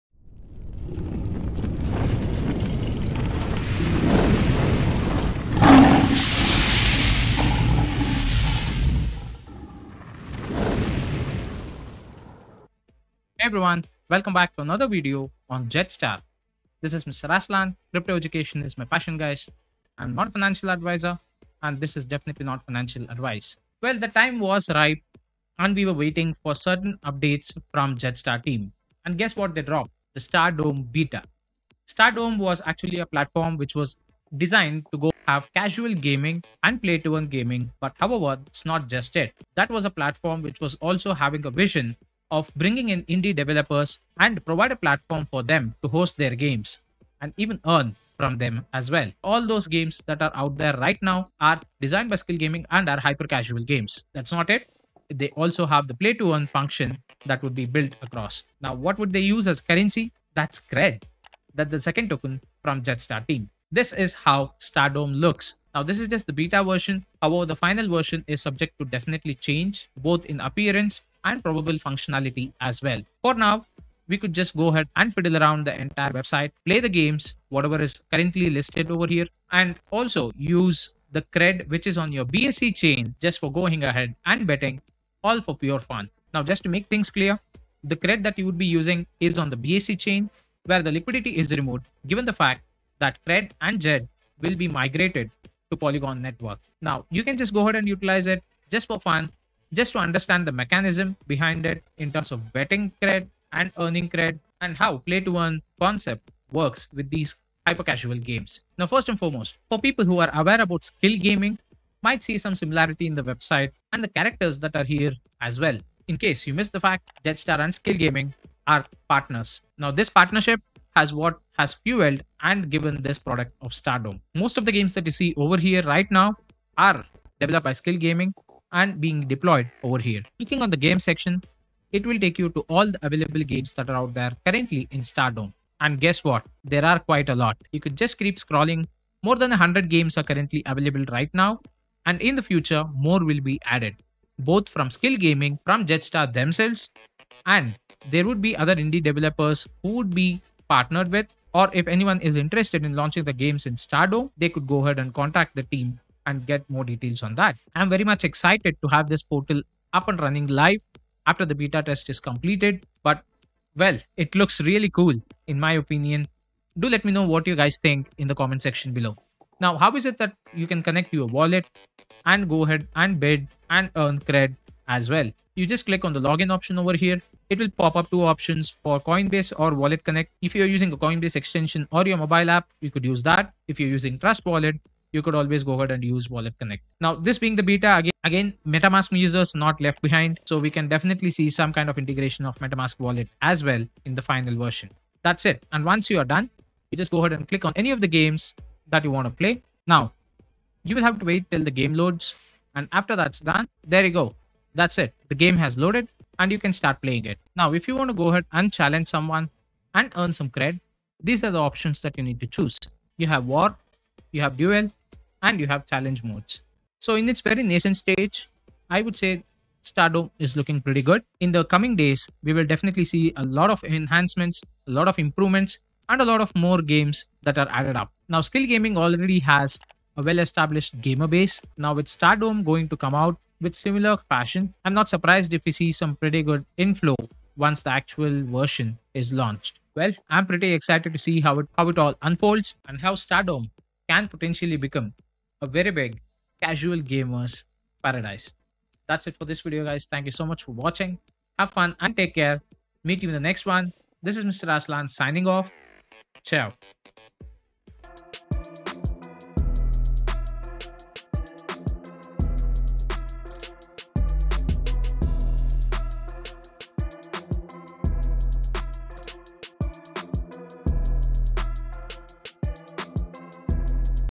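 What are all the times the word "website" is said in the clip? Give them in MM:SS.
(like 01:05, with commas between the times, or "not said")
01:16, 01:53.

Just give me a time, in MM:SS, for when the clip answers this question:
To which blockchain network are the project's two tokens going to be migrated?
01:35.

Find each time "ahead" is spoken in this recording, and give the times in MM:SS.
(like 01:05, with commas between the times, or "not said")
01:14, 01:23, 01:37, 02:34, 02:52, 03:05, 03:17, 03:28.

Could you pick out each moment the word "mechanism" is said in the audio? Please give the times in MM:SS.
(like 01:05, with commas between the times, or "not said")
01:40.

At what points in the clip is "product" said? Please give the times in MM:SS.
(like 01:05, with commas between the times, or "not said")
02:03.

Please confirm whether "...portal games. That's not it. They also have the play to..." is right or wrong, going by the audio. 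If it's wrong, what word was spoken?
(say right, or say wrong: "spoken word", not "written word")
wrong: "casual", not "portal".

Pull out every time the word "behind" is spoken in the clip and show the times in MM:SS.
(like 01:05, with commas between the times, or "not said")
01:41, 03:10.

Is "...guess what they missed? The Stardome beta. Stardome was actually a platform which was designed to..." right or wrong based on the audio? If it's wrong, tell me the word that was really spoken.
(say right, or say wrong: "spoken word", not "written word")
wrong: "dropped", not "missed".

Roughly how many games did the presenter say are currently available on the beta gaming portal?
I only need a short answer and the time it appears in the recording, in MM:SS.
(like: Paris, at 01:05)
More than 100, at 02:19.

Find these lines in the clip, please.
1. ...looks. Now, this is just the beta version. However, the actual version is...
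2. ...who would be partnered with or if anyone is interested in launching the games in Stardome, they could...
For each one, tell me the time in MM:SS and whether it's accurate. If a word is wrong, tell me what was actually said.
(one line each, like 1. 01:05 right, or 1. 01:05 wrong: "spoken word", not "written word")
1. 01:05 wrong: "final", not "actual"
2. 02:29 right.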